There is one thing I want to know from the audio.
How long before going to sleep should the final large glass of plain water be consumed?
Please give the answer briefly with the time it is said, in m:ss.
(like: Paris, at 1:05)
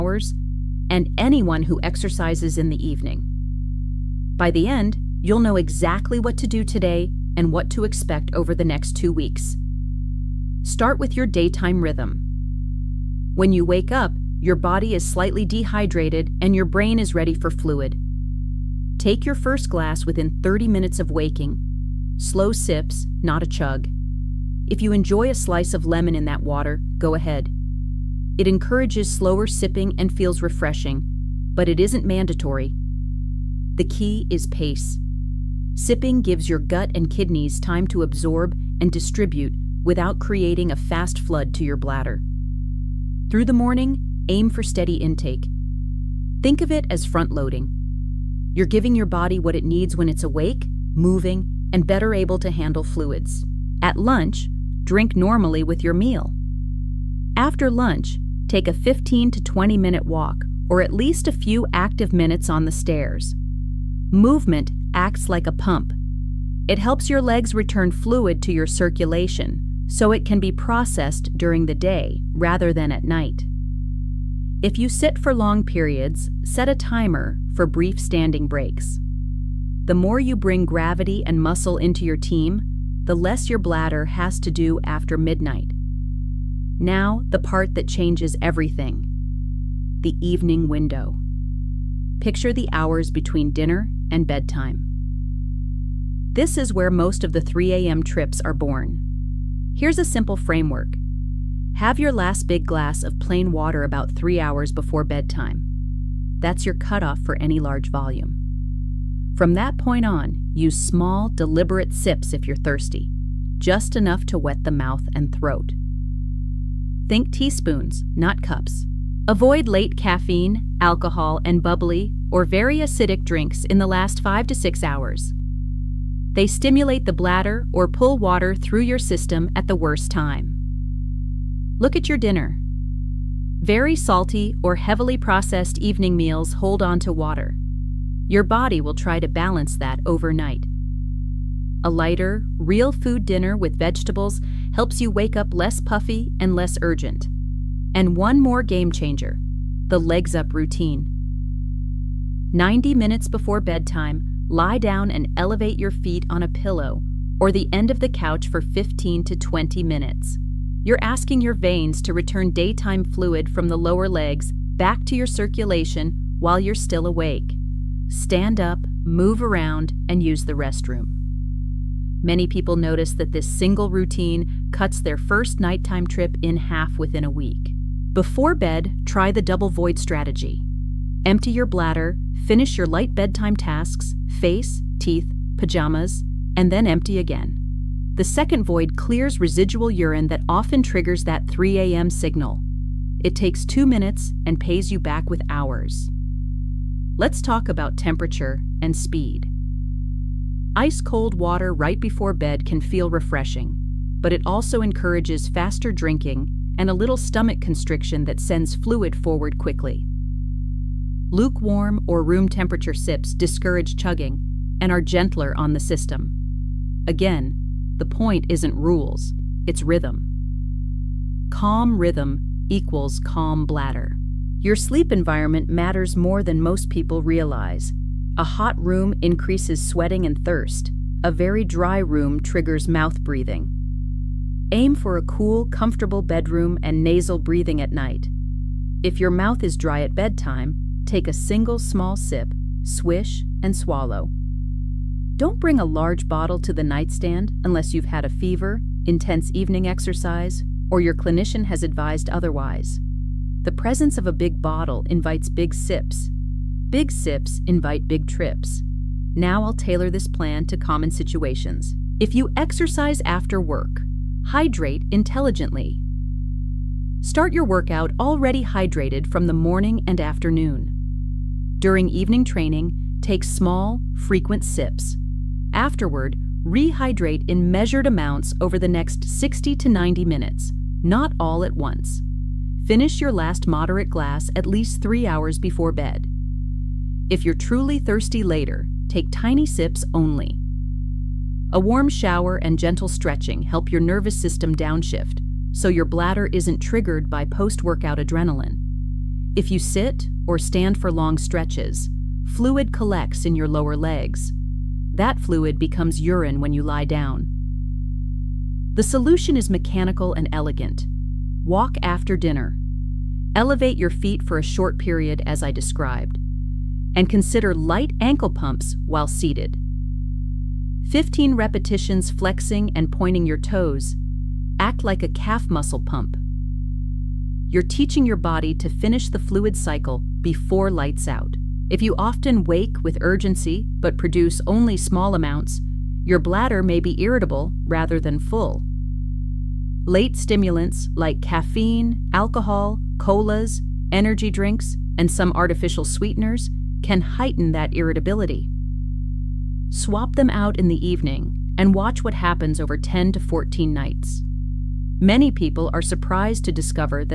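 3 hours, at 1:43.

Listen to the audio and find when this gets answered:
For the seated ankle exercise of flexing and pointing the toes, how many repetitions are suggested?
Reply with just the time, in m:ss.
5:21.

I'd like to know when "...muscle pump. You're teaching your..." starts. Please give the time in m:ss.
5:25.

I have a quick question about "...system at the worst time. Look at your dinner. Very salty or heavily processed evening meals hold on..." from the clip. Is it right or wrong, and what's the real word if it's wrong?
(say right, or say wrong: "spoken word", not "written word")
right.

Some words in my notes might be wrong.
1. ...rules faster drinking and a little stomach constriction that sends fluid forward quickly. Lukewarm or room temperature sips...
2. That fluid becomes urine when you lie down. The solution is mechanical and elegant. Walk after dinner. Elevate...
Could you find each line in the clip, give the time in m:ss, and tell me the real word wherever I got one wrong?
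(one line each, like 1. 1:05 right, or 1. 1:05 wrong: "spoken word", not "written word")
1. 3:24 wrong: "encourages", not "rules"
2. 5:05 right.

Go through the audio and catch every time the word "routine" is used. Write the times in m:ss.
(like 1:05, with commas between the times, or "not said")
2:30, 2:53.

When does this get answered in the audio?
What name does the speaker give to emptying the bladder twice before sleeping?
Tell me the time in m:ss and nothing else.
2:59.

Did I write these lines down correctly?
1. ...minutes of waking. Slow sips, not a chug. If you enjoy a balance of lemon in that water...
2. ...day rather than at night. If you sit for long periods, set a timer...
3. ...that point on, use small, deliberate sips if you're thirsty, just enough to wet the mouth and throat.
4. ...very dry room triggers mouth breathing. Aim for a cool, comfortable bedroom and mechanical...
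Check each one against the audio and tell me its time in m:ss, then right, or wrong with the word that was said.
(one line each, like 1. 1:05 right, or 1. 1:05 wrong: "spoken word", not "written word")
1. 0:20 wrong: "slice", not "balance"
2. 1:11 right
3. 1:49 right
4. 3:51 wrong: "nasal", not "mechanical".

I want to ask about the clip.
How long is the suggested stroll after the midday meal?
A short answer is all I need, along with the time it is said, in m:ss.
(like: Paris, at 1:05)
15 to 20 minutes, at 0:58.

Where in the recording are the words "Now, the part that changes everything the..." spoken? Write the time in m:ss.
1:26.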